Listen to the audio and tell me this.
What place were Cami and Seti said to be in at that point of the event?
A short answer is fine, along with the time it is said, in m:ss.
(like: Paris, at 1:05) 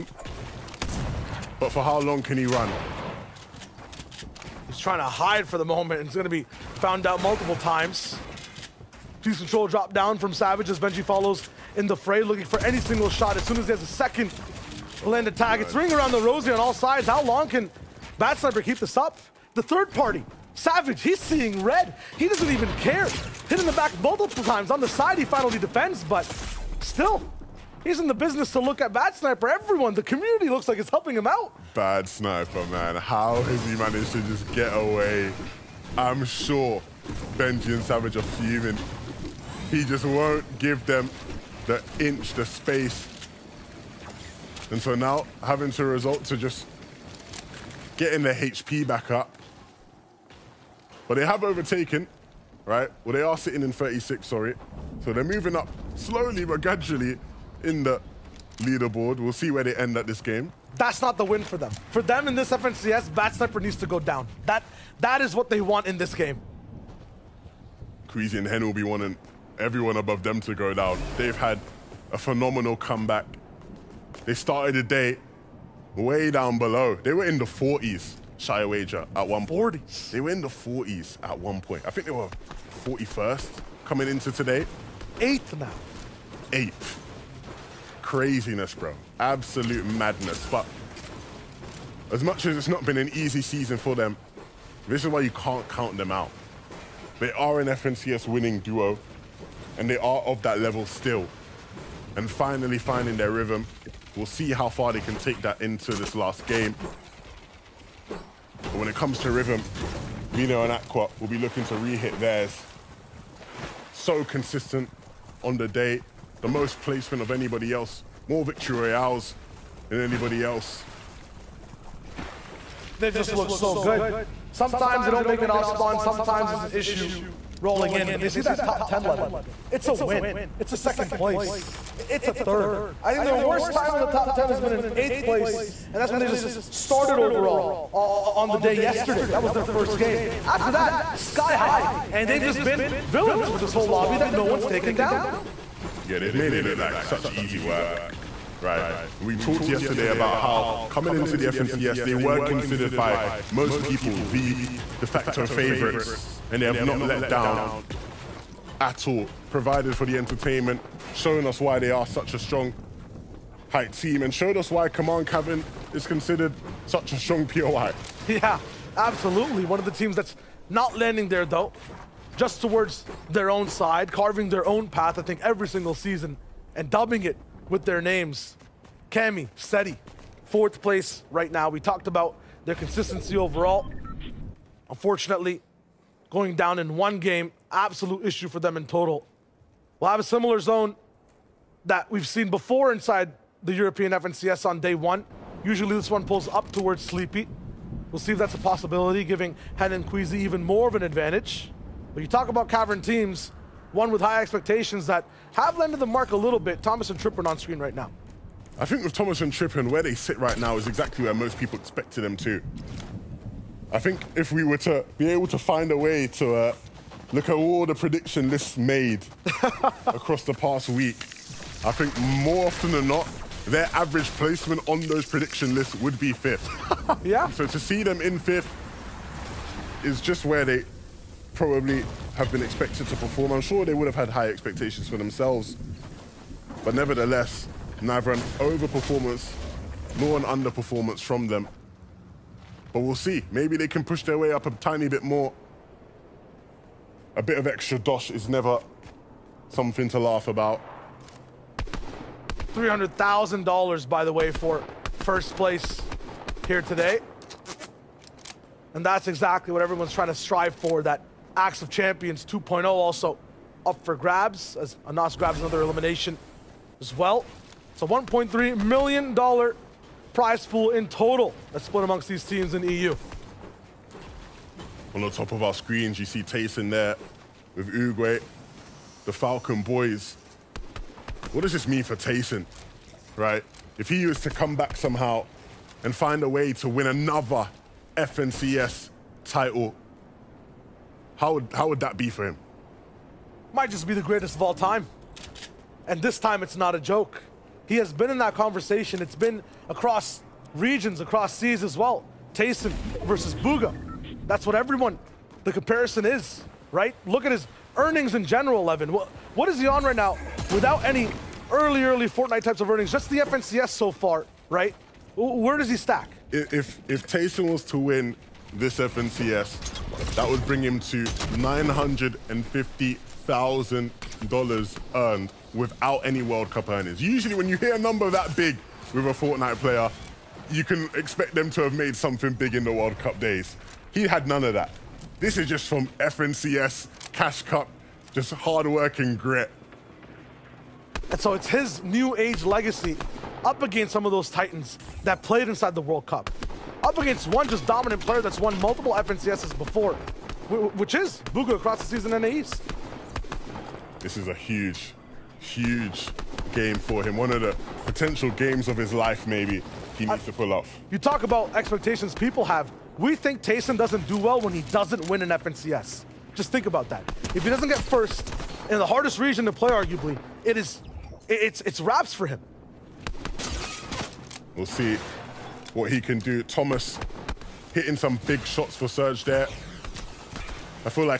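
4th, at 3:00.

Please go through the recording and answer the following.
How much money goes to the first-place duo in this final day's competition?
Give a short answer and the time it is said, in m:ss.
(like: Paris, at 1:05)
$300,000, at 4:12.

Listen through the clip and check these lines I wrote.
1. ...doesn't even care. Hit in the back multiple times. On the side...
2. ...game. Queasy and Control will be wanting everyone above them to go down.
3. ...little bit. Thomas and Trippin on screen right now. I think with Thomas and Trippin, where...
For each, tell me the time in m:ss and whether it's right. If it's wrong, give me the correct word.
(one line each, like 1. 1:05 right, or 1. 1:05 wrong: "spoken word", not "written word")
1. 0:22 right
2. 1:06 wrong: "Hen", not "Control"
3. 3:26 right.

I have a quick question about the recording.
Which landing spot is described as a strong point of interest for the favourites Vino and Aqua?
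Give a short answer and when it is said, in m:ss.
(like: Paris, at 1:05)
Command Cavern, at 2:44.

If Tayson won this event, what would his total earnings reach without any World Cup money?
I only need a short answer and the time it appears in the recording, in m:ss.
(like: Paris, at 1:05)
$950,000, at 5:21.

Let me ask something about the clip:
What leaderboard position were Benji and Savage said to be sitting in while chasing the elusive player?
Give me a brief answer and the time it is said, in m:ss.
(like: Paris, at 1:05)
36, at 0:53.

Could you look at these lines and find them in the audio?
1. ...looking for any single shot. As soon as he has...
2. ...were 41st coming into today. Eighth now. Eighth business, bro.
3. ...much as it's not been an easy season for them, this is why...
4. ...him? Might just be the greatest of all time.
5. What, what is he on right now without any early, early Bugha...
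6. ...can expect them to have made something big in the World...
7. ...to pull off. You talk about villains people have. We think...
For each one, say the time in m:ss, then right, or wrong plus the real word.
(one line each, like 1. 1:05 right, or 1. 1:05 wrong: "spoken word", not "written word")
1. 0:12 right
2. 1:22 wrong: "craziness", not "business"
3. 1:32 right
4. 4:52 right
5. 5:09 wrong: "Fortnite", not "Bugha"
6. 5:30 right
7. 6:00 wrong: "expectations", not "villains".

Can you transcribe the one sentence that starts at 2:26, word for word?
Yeah, they've made it look like such easy work, right?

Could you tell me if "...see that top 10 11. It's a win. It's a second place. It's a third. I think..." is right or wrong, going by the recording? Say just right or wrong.
right.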